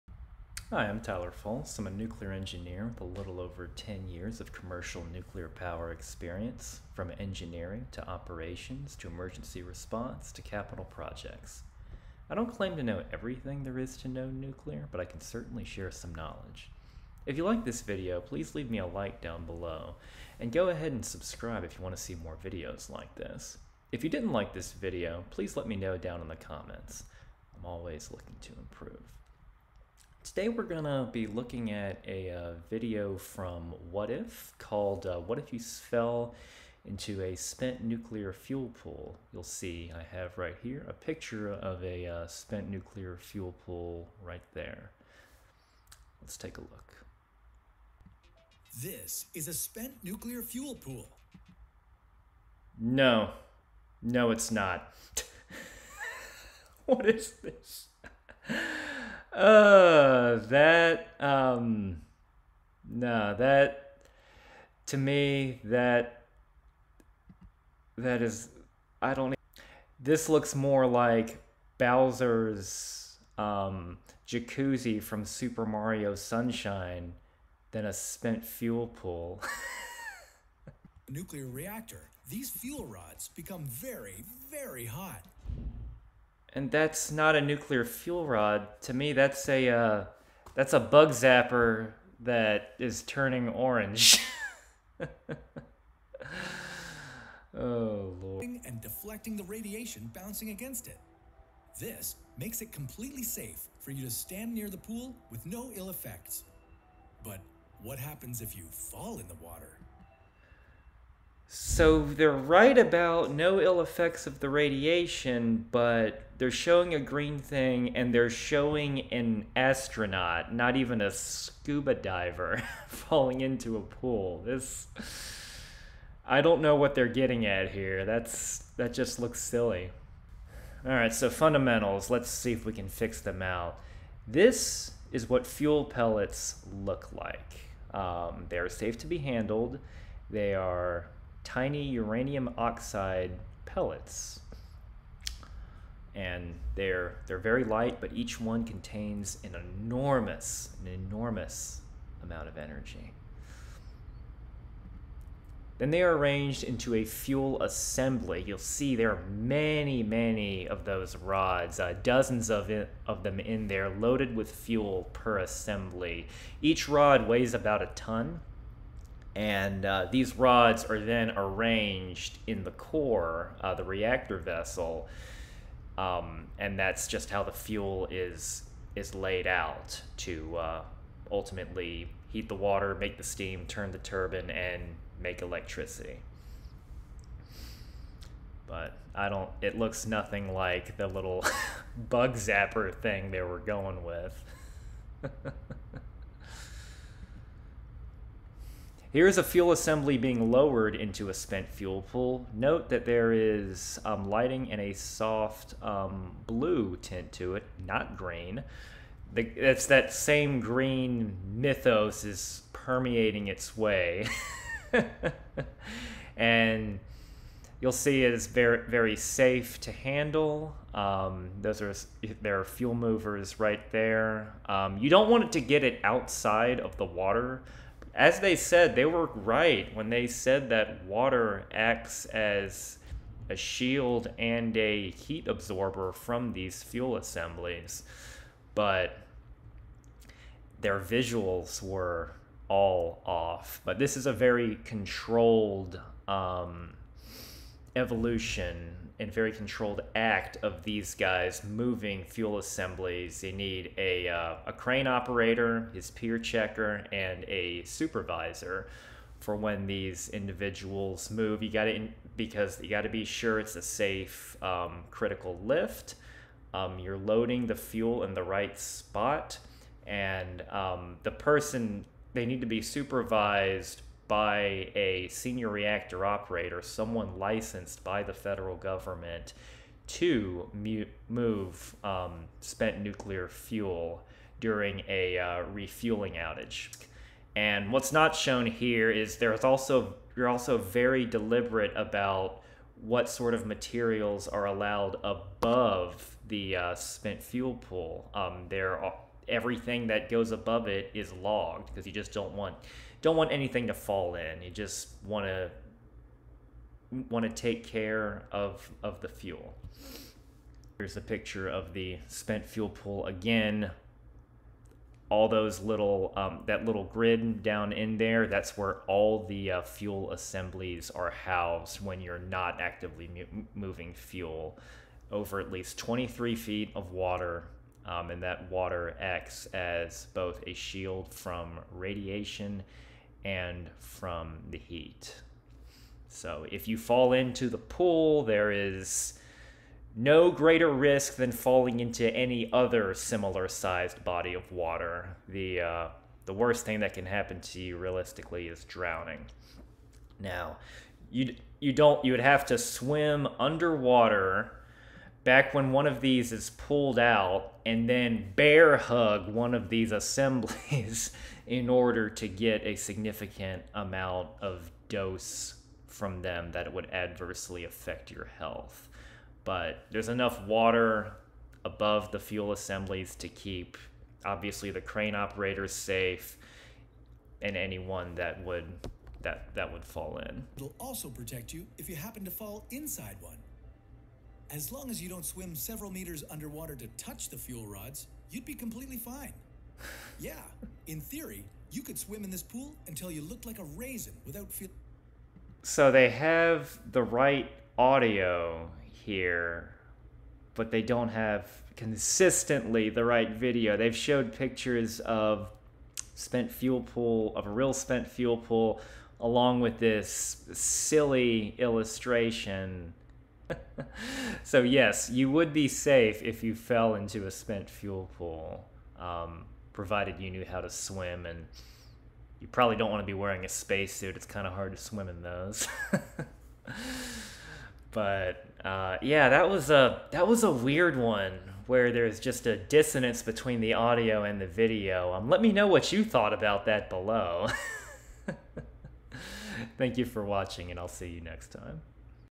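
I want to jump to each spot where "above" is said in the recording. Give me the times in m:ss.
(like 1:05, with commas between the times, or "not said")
4:55, 5:00, 6:11.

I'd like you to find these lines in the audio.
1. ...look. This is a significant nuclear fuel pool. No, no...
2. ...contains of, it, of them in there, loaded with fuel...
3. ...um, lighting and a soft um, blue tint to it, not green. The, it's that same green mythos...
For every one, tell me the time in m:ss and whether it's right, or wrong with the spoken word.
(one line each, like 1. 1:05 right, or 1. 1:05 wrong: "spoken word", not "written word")
1. 0:46 wrong: "spent", not "significant"
2. 2:42 wrong: "dozens", not "contains"
3. 3:24 right.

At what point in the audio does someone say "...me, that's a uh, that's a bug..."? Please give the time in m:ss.
1:28.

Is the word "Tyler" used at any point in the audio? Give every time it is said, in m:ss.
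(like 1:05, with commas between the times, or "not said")
0:01.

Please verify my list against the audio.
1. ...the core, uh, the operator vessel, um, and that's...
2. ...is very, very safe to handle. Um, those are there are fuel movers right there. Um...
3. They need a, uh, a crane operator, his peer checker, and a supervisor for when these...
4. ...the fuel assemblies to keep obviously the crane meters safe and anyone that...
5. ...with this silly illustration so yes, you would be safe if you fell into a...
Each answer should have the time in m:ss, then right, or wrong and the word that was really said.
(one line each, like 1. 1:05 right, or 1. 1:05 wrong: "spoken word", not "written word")
1. 2:52 wrong: "reactor", not "operator"
2. 3:38 right
3. 4:13 right
4. 6:12 wrong: "operators", not "meters"
5. 6:49 right.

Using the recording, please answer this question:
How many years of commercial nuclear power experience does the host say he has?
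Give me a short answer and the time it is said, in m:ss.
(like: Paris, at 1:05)
a little over 10, at 0:03.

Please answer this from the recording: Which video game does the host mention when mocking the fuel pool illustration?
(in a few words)
Super Mario Sunshine.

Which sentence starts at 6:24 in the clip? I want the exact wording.
As long as you don't swim several meters underwater to touch the fuel rods, you'd be completely fine.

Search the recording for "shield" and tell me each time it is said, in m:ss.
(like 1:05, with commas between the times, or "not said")
3:53, 5:30.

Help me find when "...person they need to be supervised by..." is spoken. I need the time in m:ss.
4:31.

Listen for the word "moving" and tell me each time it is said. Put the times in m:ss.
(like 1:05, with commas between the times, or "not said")
4:11, 5:23.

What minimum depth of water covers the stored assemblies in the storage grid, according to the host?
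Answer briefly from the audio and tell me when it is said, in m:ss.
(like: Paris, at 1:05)
23 feet, at 5:25.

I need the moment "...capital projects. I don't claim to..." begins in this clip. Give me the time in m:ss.
0:10.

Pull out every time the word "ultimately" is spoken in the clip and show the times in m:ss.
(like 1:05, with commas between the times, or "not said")
3:01.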